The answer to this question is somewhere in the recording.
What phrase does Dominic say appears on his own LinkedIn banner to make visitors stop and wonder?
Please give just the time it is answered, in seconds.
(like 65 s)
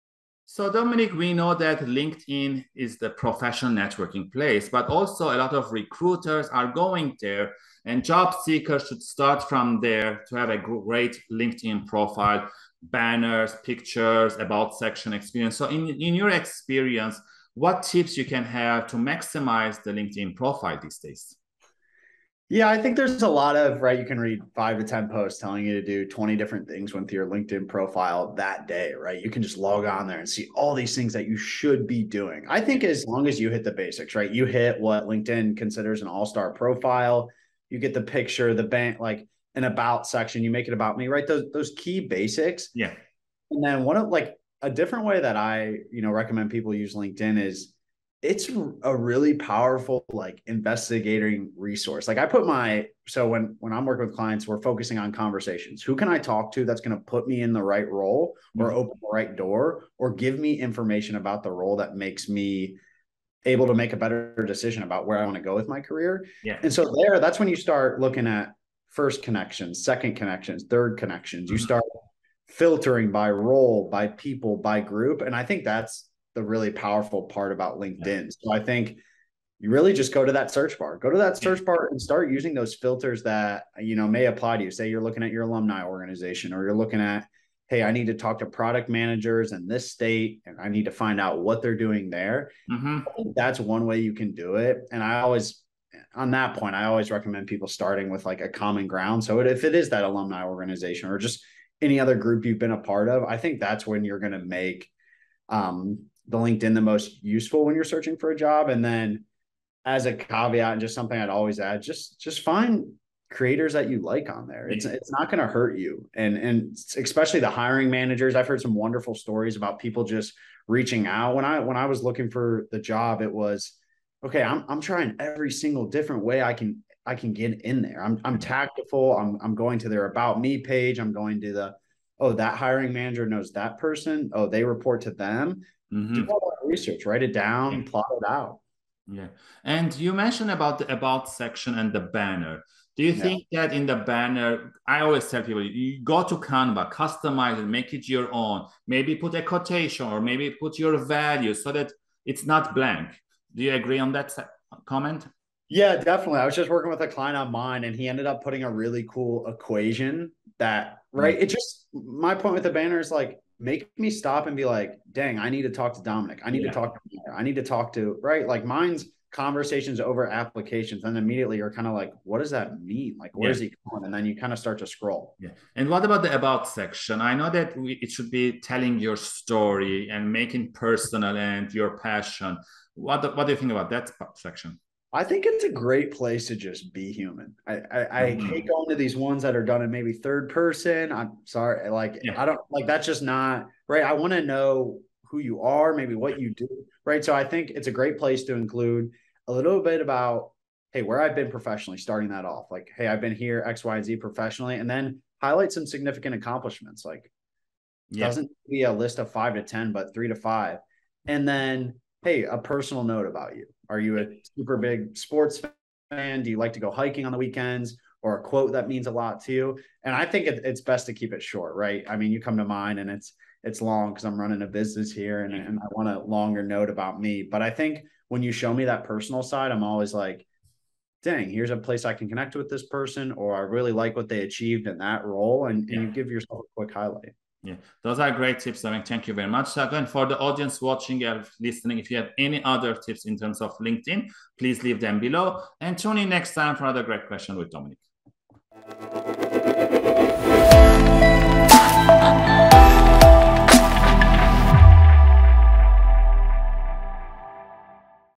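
169 s.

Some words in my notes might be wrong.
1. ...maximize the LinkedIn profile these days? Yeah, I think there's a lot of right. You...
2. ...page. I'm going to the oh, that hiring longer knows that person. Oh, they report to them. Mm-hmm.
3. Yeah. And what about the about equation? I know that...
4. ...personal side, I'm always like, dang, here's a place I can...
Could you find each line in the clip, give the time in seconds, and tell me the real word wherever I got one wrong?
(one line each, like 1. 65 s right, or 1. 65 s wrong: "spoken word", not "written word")
1. 18 s right
2. 130 s wrong: "manager", not "longer"
3. 175 s wrong: "section", not "equation"
4. 229 s right.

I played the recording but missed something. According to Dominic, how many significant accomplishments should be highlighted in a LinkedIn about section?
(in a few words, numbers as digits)
3 to 5.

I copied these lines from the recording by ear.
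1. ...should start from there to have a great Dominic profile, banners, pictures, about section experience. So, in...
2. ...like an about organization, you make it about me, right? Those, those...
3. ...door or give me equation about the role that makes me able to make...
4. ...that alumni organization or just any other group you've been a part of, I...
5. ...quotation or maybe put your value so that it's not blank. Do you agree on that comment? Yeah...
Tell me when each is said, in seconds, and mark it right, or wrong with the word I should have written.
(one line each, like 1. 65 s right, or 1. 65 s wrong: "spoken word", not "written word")
1. 8 s wrong: "LinkedIn", not "Dominic"
2. 38 s wrong: "section", not "organization"
3. 59 s wrong: "information", not "equation"
4. 99 s right
5. 149 s right.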